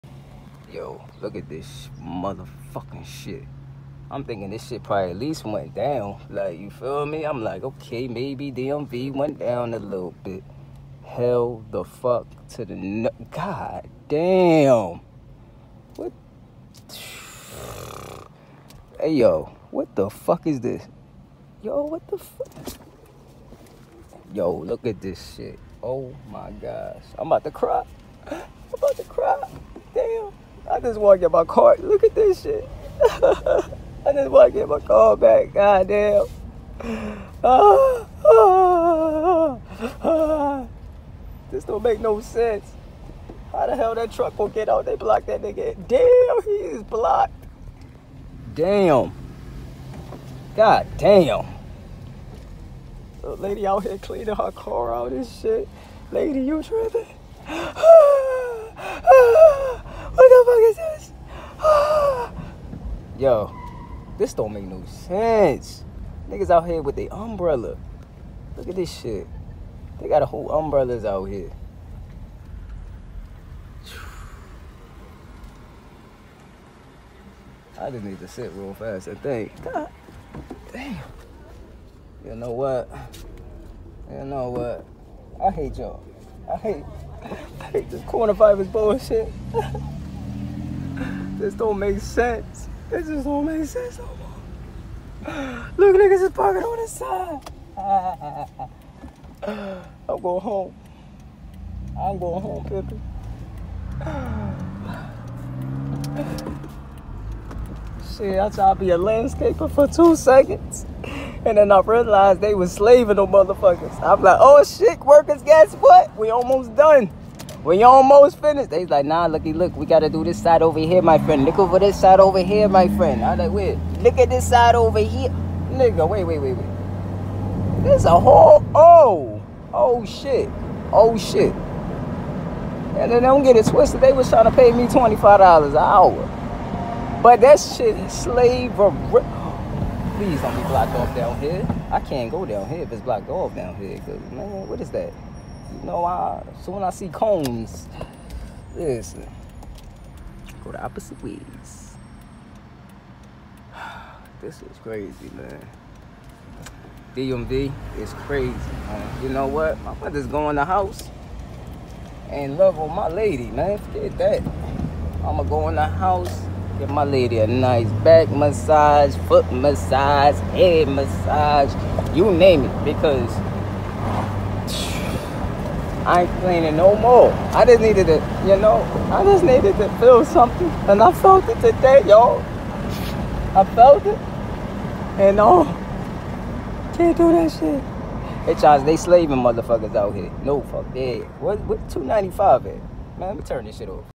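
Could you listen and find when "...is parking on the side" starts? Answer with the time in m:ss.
1:36.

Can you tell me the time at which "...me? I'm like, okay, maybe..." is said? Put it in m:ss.
0:07.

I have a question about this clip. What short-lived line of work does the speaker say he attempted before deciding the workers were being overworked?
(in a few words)
Landscaper.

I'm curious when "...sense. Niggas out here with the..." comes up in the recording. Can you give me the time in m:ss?
1:04.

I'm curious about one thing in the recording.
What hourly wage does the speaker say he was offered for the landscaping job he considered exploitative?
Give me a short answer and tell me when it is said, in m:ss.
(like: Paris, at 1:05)
$25, at 2:14.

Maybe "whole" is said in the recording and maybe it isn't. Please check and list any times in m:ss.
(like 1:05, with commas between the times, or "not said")
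1:10, 2:08.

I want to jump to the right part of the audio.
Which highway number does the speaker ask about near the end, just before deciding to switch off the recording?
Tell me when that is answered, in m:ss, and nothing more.
3:11.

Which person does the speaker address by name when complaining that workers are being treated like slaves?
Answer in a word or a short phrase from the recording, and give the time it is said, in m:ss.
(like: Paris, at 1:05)
Charles, at 3:08.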